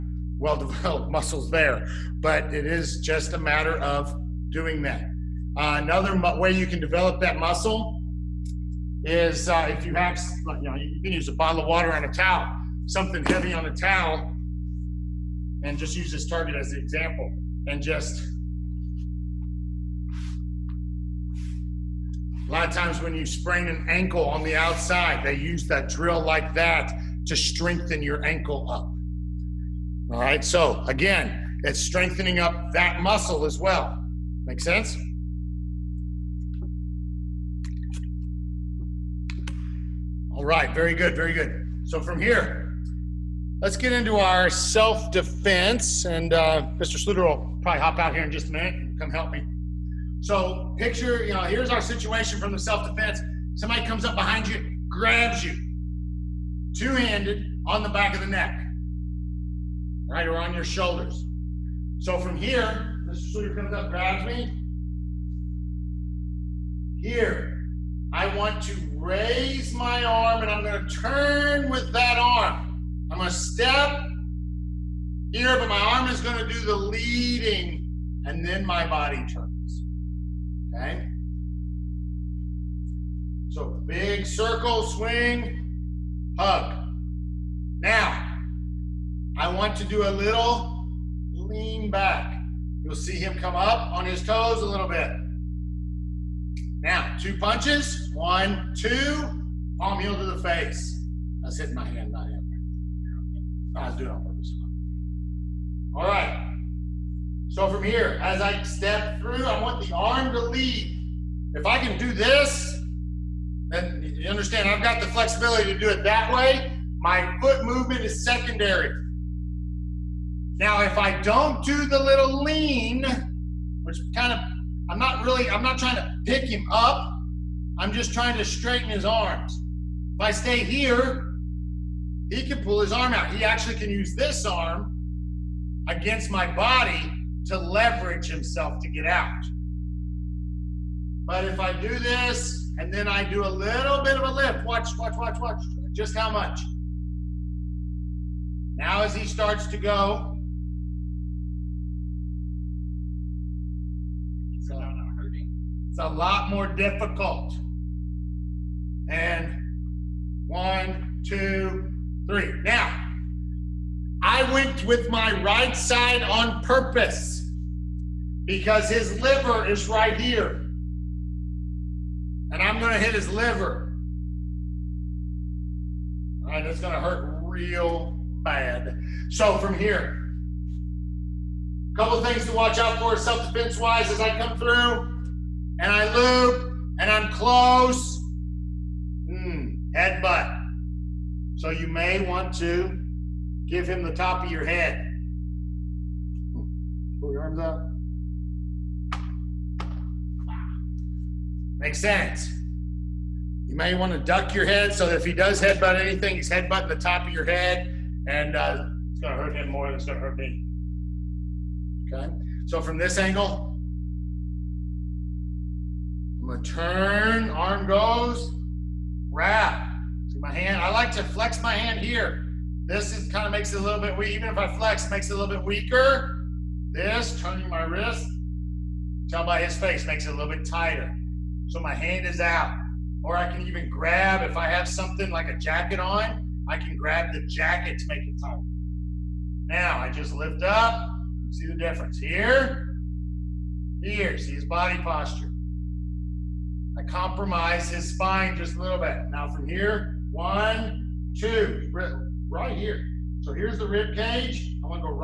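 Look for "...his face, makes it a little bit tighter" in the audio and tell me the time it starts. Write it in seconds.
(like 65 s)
229 s.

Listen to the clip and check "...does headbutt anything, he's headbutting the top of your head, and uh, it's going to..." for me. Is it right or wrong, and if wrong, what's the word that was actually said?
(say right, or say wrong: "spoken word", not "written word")
right.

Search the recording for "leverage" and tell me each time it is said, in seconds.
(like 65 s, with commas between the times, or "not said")
137 s.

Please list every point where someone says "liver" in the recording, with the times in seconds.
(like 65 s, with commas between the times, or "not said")
169 s, 173 s.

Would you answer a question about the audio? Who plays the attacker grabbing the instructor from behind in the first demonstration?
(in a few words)
Mr. Sawyer.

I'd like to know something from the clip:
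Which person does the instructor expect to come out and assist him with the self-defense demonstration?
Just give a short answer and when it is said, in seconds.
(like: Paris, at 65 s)
Mr. Sluter, at 46 s.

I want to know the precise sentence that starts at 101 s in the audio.
I was hitting my hand, not him.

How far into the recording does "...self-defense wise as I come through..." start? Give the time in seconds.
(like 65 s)
183 s.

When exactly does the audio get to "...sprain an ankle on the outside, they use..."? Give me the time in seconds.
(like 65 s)
23 s.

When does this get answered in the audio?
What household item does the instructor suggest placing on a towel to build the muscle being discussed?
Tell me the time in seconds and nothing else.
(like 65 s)
11 s.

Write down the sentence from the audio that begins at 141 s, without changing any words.
But if I do this and then I do a little bit of a lift, watch, watch, watch, watch, just how much.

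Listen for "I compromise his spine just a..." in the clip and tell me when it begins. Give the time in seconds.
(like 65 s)
246 s.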